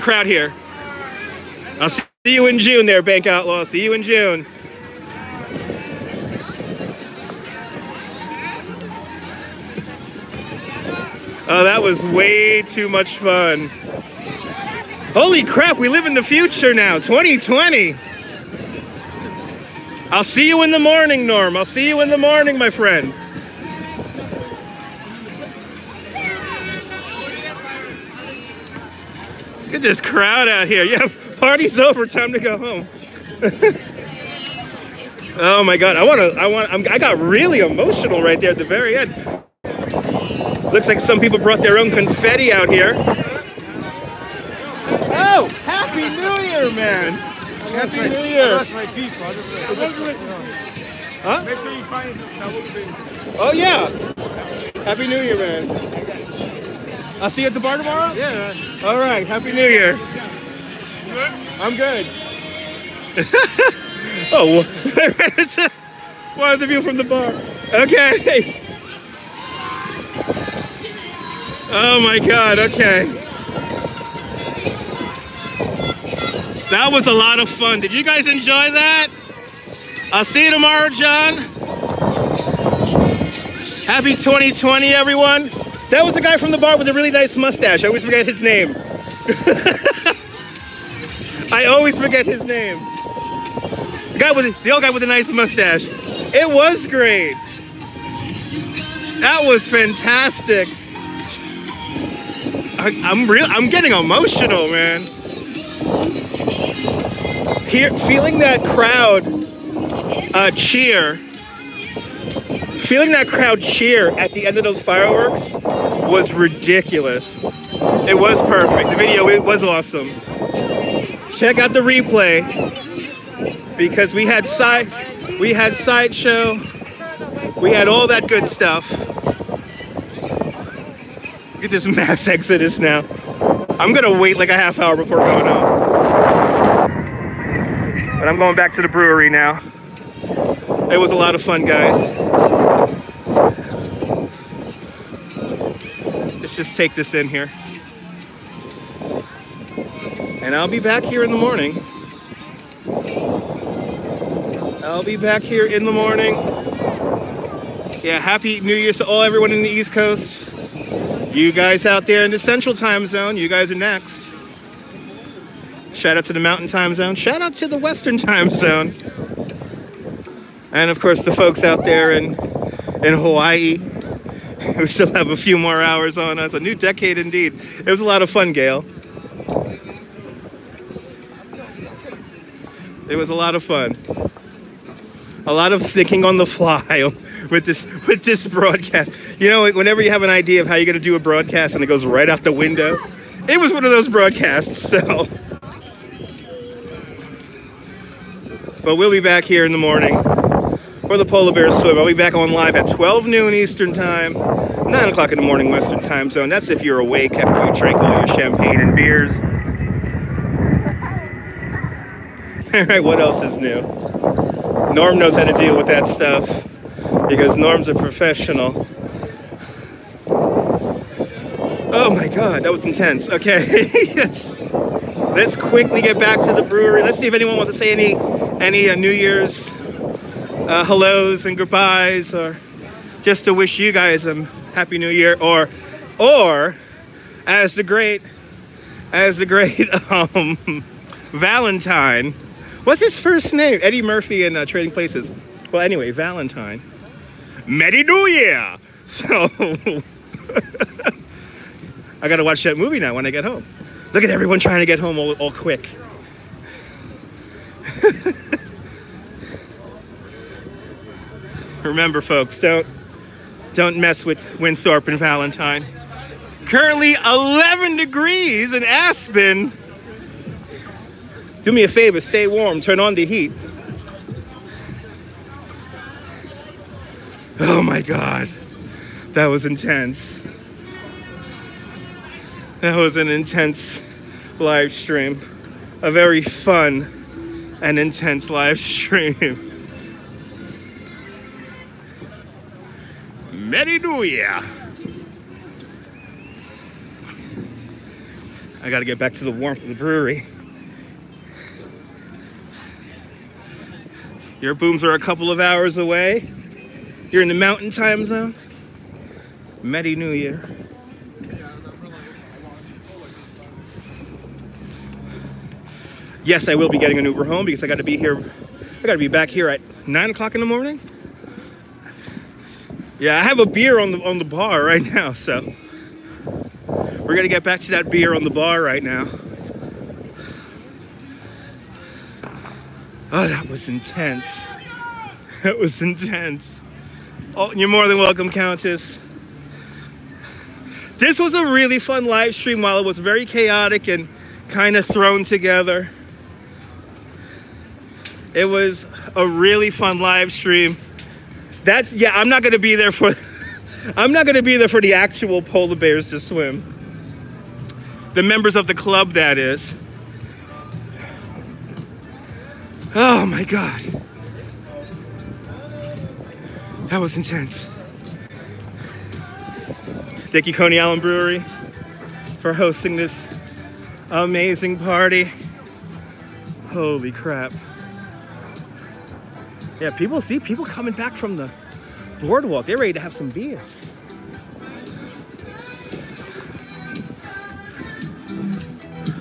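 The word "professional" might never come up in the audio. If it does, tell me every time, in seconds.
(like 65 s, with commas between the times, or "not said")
217 s.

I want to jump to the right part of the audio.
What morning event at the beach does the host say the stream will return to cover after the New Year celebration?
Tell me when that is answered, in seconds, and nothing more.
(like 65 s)
201 s.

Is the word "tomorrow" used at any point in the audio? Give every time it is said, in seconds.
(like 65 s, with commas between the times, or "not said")
57 s, 80 s.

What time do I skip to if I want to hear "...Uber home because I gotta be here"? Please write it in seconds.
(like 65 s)
317 s.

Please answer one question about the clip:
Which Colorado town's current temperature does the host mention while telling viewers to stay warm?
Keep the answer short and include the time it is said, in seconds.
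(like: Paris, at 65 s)
Aspen, at 268 s.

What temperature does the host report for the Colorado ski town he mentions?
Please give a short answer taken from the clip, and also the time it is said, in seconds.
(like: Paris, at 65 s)
11 degrees, at 267 s.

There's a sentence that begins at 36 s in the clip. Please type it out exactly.
I'm, I got really emotional right there at the very end.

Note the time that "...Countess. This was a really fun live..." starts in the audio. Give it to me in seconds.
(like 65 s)
338 s.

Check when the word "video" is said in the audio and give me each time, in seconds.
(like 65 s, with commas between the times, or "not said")
118 s.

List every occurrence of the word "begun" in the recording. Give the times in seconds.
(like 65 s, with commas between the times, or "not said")
not said.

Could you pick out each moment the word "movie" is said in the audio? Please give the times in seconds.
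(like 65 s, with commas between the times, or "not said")
252 s.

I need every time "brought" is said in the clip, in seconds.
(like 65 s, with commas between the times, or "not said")
41 s.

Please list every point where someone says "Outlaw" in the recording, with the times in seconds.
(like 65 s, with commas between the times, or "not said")
3 s.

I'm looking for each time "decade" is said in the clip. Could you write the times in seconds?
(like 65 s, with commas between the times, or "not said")
176 s.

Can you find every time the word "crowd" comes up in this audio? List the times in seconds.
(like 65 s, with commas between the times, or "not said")
0 s, 30 s, 108 s, 113 s.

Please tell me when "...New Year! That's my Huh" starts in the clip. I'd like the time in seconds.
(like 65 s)
48 s.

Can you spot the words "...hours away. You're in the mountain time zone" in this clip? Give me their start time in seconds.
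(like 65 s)
305 s.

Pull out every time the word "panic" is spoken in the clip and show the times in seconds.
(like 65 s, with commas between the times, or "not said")
not said.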